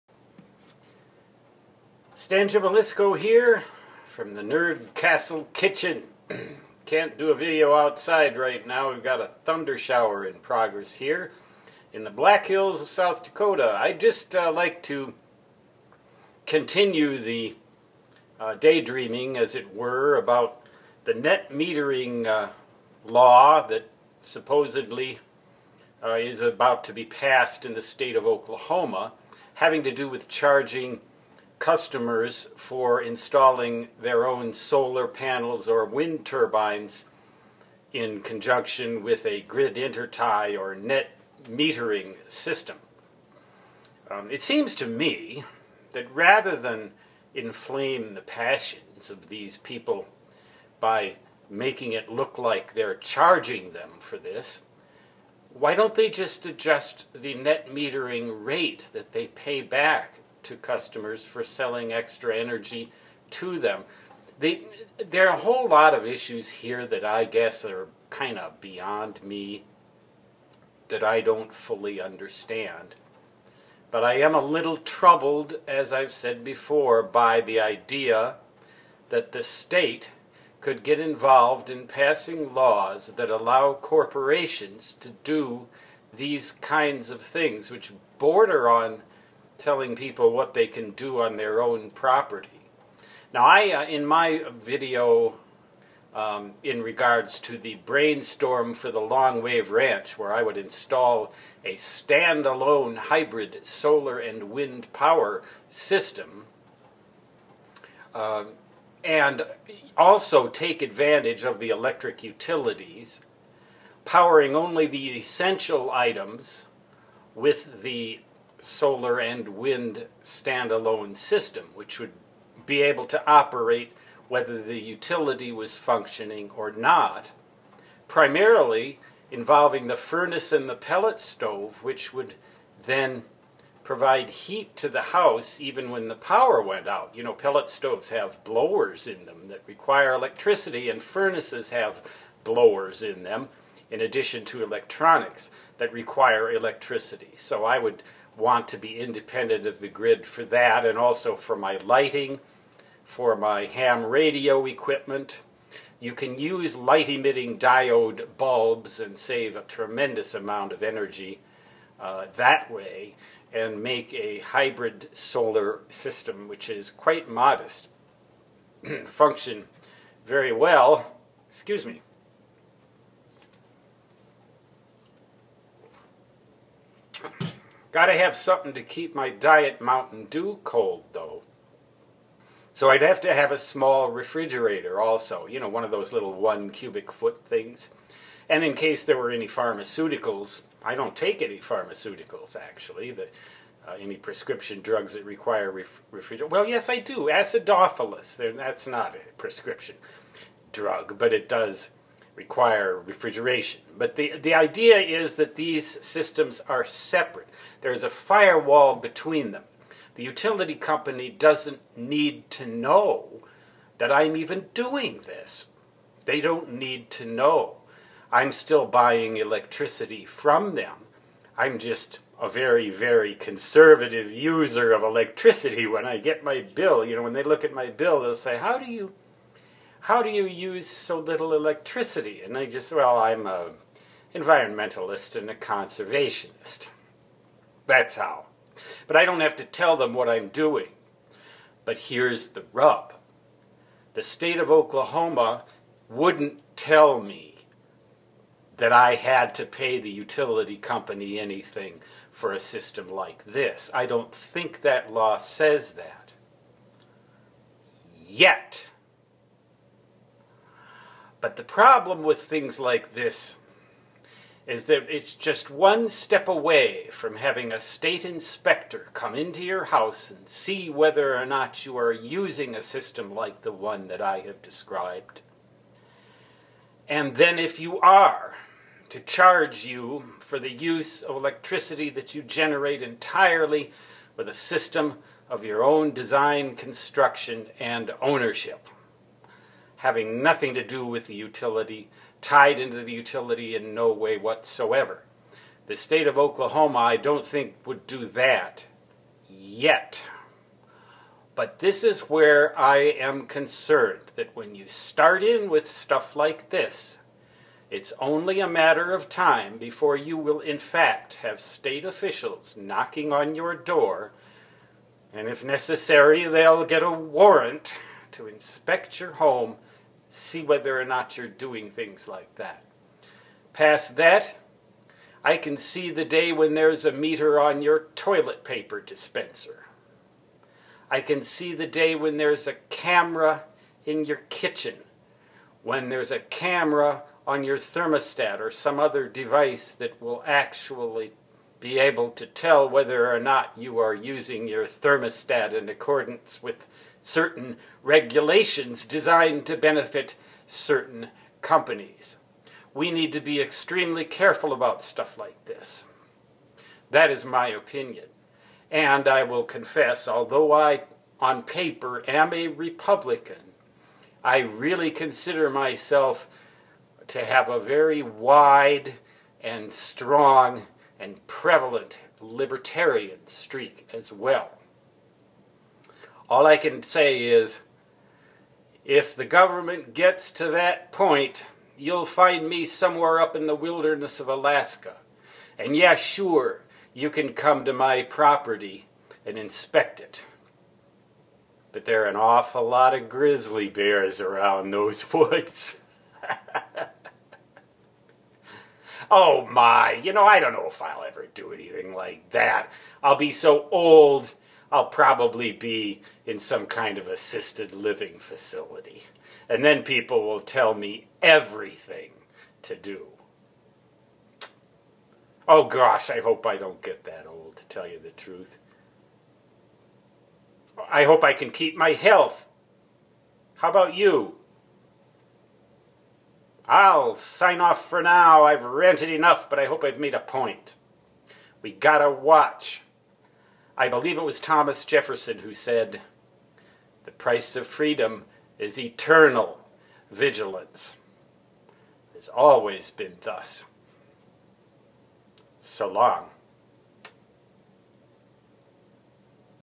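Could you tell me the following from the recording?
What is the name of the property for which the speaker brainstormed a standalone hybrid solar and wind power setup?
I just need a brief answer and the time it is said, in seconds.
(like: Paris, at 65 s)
Longwave Ranch, at 98 s.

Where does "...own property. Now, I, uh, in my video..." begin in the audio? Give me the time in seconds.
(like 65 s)
91 s.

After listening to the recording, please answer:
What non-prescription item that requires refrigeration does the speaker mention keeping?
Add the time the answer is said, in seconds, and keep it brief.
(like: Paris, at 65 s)
Acidophilus, at 197 s.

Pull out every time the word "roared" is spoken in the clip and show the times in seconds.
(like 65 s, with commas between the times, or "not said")
not said.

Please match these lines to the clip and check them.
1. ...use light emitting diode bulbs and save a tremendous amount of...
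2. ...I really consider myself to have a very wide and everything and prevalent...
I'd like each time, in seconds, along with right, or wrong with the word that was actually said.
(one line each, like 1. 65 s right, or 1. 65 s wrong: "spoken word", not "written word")
1. 156 s right
2. 364 s wrong: "strong", not "everything".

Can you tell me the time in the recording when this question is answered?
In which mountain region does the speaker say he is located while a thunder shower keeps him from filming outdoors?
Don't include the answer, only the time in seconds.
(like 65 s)
12 s.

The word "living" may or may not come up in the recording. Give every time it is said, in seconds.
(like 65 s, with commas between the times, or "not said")
407 s.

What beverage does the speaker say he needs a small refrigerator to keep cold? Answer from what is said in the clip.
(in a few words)
Diet Mountain Dew.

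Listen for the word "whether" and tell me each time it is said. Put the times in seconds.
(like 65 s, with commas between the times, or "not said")
124 s, 270 s, 320 s, 342 s.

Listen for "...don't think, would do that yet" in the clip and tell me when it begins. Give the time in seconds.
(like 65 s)
297 s.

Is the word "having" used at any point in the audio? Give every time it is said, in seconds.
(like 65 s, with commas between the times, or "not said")
29 s, 267 s, 290 s.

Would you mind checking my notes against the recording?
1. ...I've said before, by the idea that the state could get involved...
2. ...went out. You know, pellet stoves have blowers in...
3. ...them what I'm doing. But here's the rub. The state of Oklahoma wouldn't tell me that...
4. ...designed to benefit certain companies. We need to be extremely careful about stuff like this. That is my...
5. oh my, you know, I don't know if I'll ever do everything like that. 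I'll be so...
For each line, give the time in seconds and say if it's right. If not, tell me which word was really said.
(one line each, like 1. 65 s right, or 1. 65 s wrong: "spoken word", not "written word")
1. 75 s right
2. 136 s right
3. 239 s right
4. 349 s right
5. 399 s wrong: "anything", not "everything".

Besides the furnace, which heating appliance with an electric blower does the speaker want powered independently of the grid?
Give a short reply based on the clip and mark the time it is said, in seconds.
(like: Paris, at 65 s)
Pellet stove, at 130 s.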